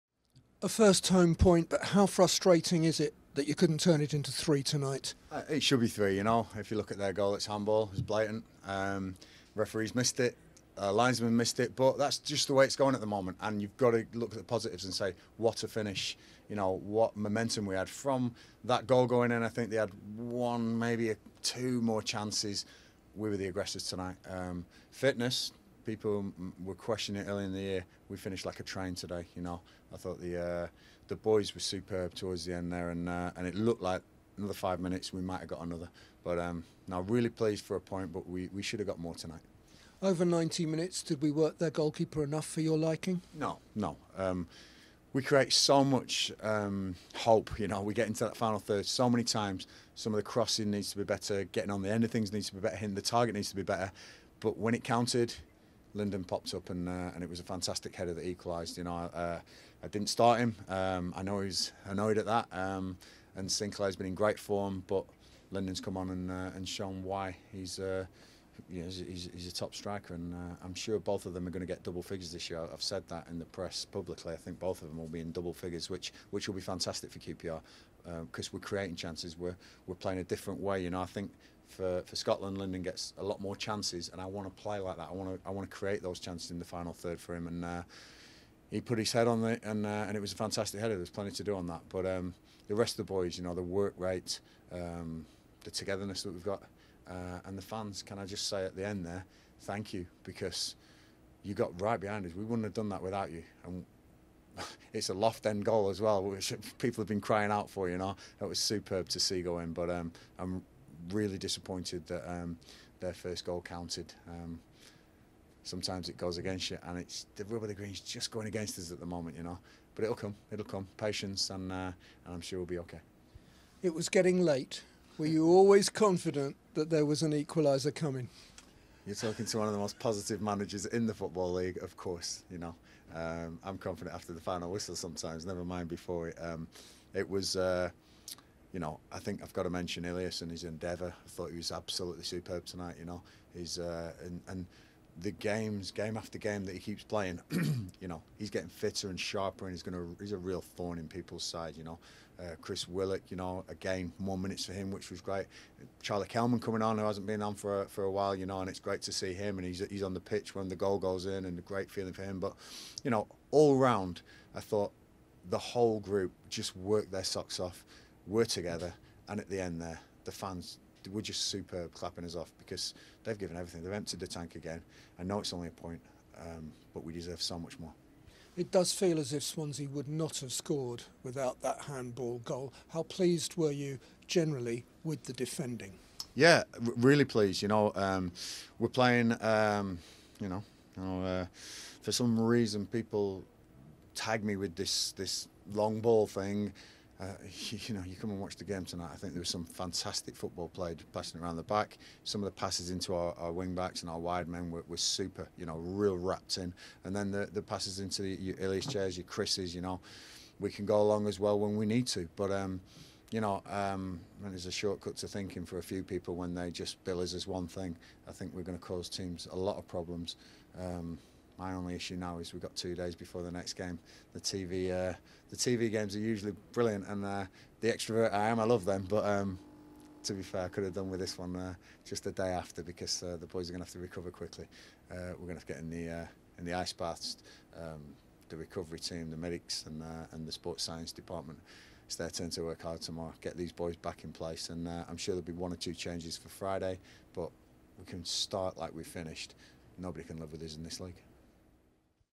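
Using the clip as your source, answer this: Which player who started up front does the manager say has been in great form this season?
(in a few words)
Sinclair.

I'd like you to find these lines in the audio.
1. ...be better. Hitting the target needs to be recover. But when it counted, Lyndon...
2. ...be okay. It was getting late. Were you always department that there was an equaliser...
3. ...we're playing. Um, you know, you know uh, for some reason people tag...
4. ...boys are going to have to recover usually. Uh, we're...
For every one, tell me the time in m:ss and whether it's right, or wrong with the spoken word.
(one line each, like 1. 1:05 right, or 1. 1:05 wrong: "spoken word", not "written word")
1. 0:52 wrong: "better", not "recover"
2. 2:02 wrong: "confident", not "department"
3. 3:08 right
4. 3:53 wrong: "quickly", not "usually".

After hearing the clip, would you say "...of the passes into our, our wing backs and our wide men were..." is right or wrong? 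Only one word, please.
right.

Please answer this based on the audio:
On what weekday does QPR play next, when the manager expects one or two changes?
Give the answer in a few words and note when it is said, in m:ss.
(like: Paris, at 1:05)
Friday, at 4:06.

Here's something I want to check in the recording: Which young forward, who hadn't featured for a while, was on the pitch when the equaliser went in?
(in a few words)
Charlie Kelman.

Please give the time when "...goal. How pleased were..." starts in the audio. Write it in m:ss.
3:02.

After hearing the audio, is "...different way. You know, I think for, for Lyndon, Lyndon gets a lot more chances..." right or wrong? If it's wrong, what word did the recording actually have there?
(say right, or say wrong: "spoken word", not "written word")
wrong: "Scotland", not "Lyndon".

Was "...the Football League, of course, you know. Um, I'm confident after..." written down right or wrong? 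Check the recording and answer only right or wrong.
right.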